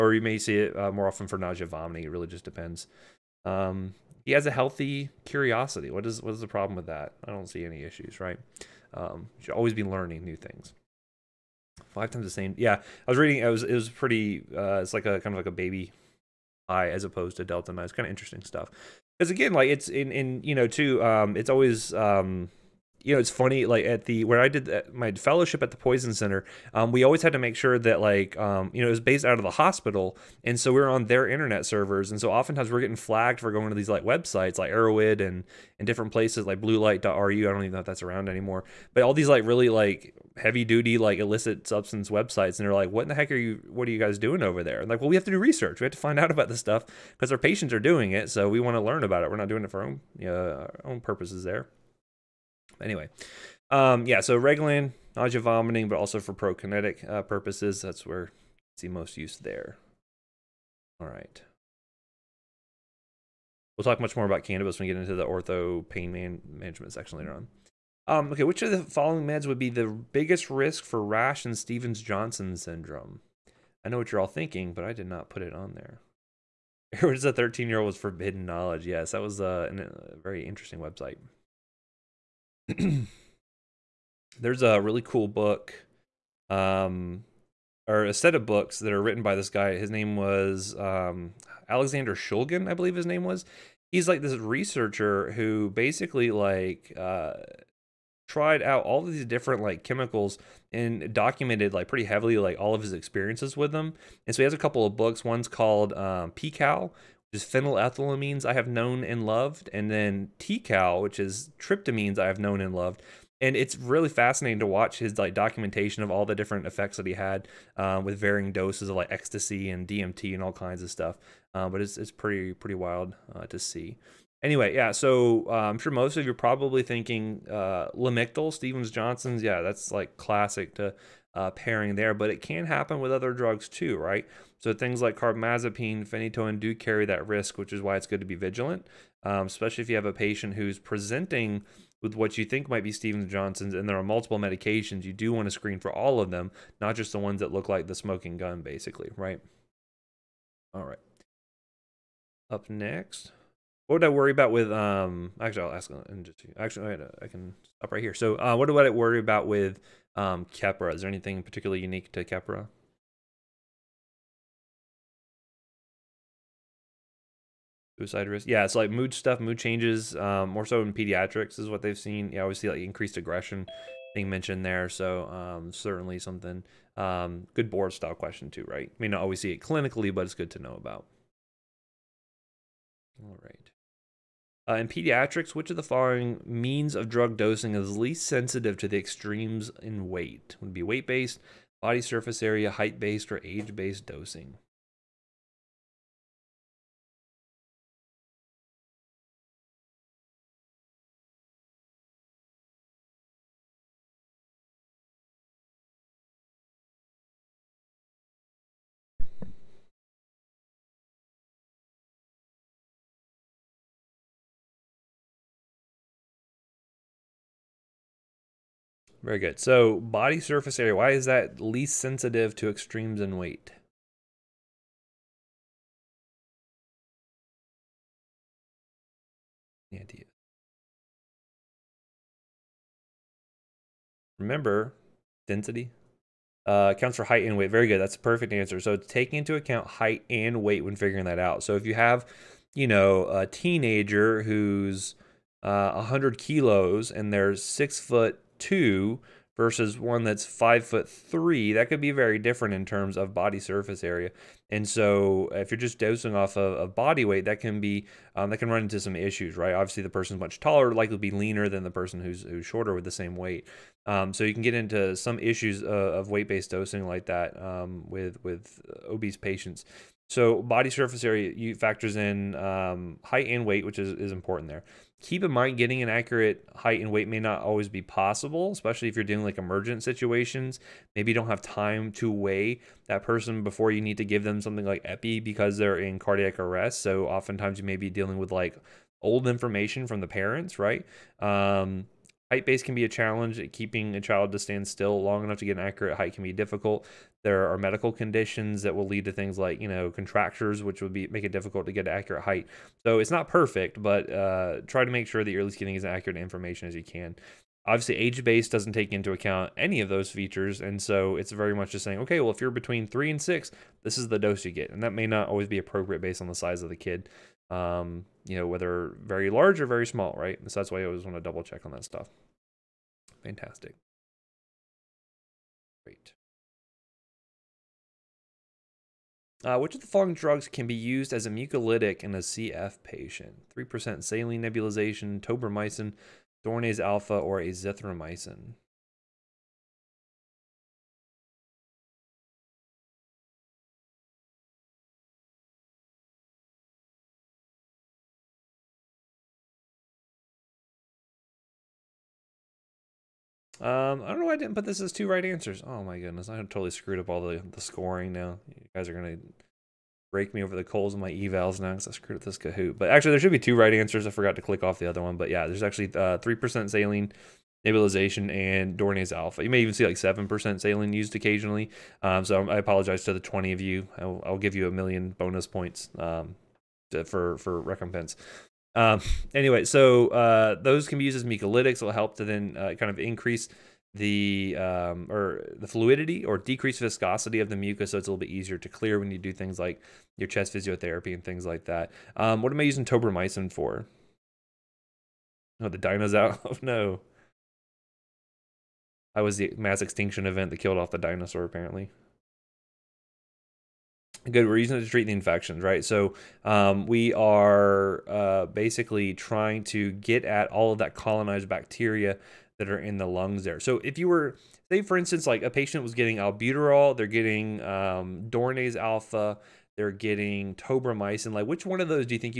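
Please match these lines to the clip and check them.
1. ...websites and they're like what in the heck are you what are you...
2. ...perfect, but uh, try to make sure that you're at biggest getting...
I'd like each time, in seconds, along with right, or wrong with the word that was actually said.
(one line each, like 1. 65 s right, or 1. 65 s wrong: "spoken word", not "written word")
1. 42 s right
2. 303 s wrong: "least", not "biggest".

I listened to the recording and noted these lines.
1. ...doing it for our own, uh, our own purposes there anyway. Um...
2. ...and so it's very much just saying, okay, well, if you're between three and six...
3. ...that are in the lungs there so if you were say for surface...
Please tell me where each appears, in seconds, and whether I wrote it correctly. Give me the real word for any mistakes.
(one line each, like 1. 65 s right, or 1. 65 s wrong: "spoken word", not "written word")
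1. 49 s right
2. 310 s right
3. 412 s wrong: "instance", not "surface".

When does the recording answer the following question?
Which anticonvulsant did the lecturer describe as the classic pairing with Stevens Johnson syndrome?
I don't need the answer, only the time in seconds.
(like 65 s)
127 s.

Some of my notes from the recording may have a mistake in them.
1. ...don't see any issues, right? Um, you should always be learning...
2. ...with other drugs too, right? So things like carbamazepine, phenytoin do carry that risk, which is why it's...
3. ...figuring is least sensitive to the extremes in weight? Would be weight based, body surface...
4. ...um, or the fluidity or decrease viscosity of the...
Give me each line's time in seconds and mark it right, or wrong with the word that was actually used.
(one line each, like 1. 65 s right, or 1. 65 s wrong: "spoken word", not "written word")
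1. 7 s right
2. 133 s right
3. 187 s wrong: "dosing", not "figuring"
4. 384 s right.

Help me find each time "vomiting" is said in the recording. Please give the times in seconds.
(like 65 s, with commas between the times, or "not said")
1 s, 55 s.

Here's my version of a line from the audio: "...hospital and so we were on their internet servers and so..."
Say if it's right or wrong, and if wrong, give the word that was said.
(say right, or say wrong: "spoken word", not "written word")
right.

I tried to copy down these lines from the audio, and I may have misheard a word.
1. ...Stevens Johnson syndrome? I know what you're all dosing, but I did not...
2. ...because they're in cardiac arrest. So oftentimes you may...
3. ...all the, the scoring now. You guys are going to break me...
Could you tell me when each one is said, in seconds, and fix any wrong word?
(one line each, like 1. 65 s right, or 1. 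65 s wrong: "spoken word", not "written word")
1. 71 s wrong: "thinking", not "dosing"
2. 285 s right
3. 357 s right.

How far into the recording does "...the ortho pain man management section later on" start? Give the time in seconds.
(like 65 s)
65 s.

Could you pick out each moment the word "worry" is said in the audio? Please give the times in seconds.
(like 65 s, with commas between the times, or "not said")
154 s, 158 s.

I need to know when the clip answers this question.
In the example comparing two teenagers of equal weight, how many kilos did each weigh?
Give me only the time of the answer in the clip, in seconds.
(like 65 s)
245 s.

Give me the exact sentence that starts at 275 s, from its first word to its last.
Keep in mind getting an accurate height and weight may not always be possible, especially if you're dealing like emergent situations.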